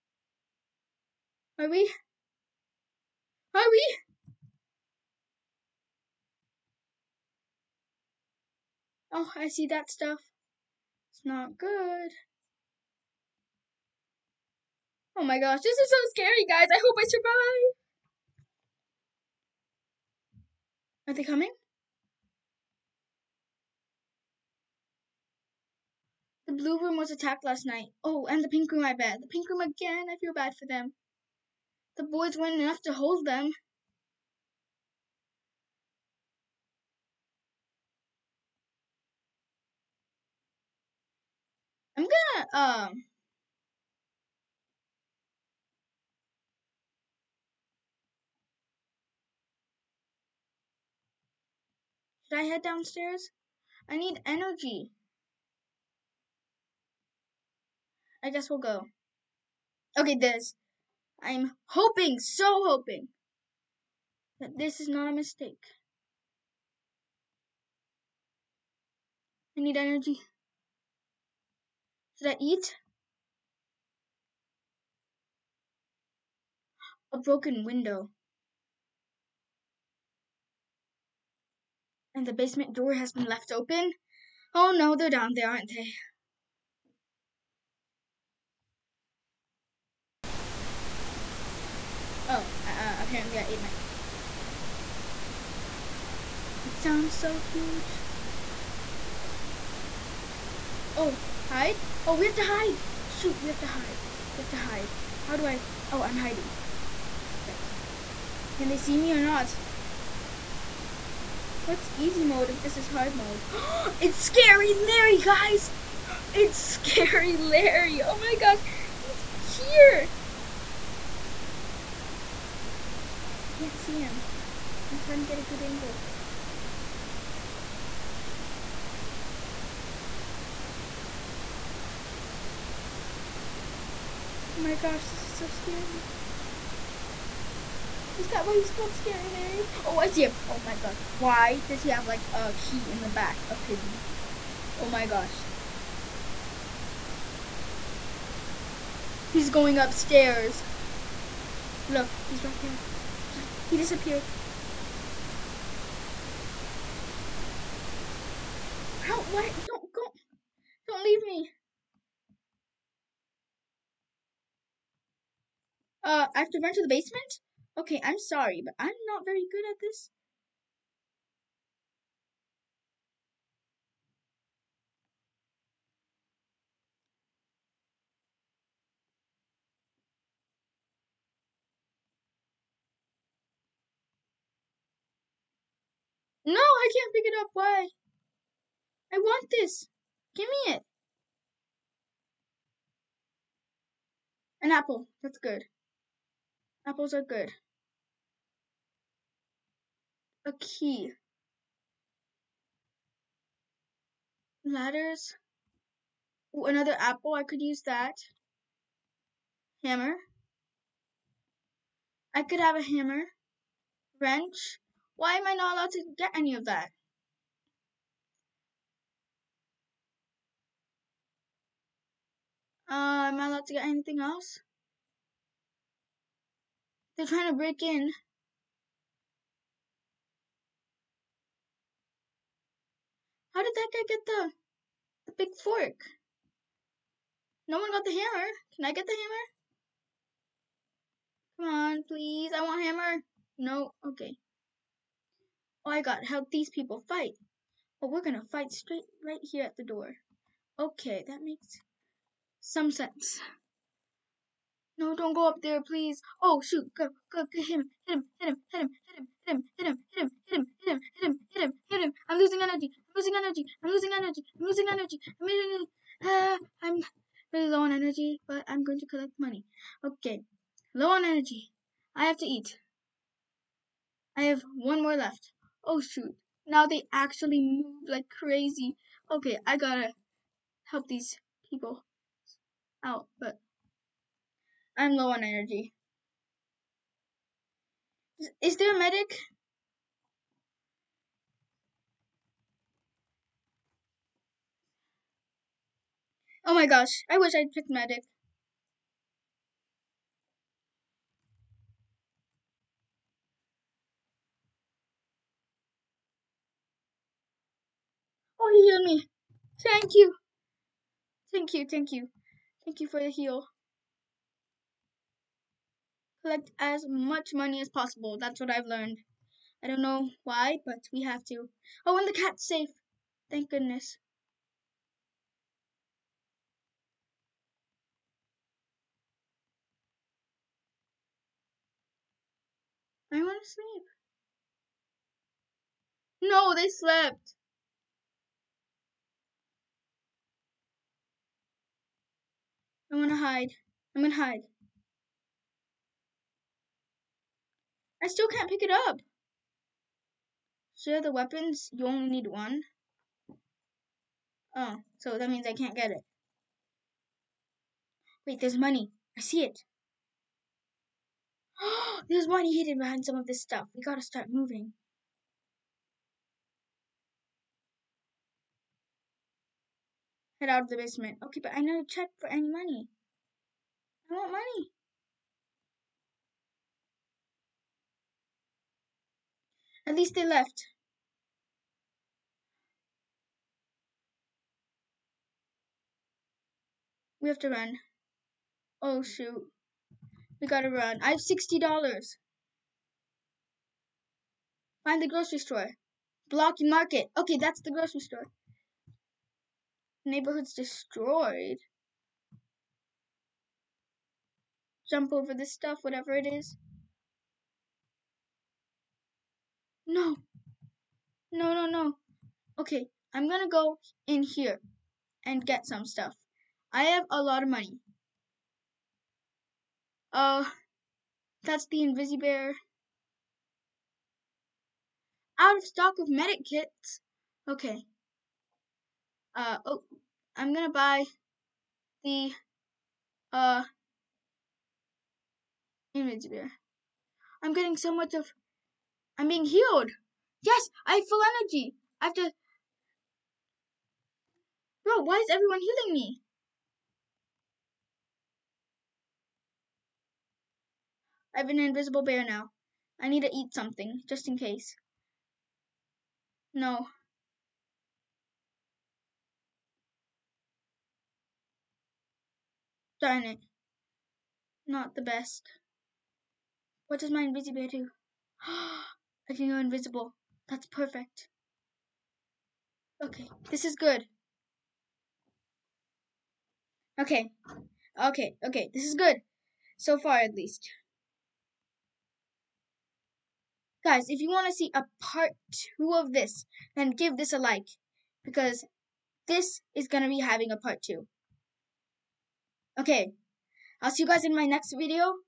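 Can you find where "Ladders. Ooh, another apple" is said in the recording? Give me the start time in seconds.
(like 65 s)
204 s.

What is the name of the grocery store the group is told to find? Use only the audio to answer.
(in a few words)
Blocky Market.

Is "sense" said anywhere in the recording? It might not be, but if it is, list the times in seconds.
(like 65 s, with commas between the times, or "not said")
252 s.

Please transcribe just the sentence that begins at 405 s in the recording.
Jump over this stuff, whatever it is.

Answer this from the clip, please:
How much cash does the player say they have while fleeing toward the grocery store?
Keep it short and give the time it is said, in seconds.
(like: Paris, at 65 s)
$60, at 391 s.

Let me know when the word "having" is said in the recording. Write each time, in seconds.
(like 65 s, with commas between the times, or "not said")
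490 s.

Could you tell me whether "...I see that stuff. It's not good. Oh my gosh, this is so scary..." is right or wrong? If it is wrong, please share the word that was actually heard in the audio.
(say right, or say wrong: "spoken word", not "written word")
right.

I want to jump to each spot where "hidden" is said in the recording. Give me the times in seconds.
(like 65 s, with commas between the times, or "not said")
362 s.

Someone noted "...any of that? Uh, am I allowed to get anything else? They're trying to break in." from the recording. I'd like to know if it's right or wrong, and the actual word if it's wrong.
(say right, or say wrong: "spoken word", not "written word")
right.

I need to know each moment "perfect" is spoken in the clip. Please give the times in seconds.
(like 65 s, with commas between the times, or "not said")
107 s, 470 s.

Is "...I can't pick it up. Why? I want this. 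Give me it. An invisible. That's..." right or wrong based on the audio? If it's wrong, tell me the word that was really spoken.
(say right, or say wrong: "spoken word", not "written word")
wrong: "apple", not "invisible".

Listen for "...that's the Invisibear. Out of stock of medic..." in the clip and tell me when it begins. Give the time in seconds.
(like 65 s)
421 s.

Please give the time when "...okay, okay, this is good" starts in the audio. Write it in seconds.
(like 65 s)
478 s.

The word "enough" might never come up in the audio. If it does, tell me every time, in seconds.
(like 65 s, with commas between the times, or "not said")
32 s.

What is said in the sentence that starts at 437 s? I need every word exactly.
I'm getting so much of, I'm being healed.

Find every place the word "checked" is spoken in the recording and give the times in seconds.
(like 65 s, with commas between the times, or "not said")
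372 s.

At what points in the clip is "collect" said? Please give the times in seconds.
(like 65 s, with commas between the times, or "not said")
269 s, 316 s.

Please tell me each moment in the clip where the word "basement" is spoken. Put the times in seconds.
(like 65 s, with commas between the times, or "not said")
82 s, 166 s, 370 s.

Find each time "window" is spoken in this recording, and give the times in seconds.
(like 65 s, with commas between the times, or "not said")
77 s.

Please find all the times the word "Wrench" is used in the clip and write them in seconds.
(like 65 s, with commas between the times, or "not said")
214 s.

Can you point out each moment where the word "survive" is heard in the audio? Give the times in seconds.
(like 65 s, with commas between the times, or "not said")
17 s.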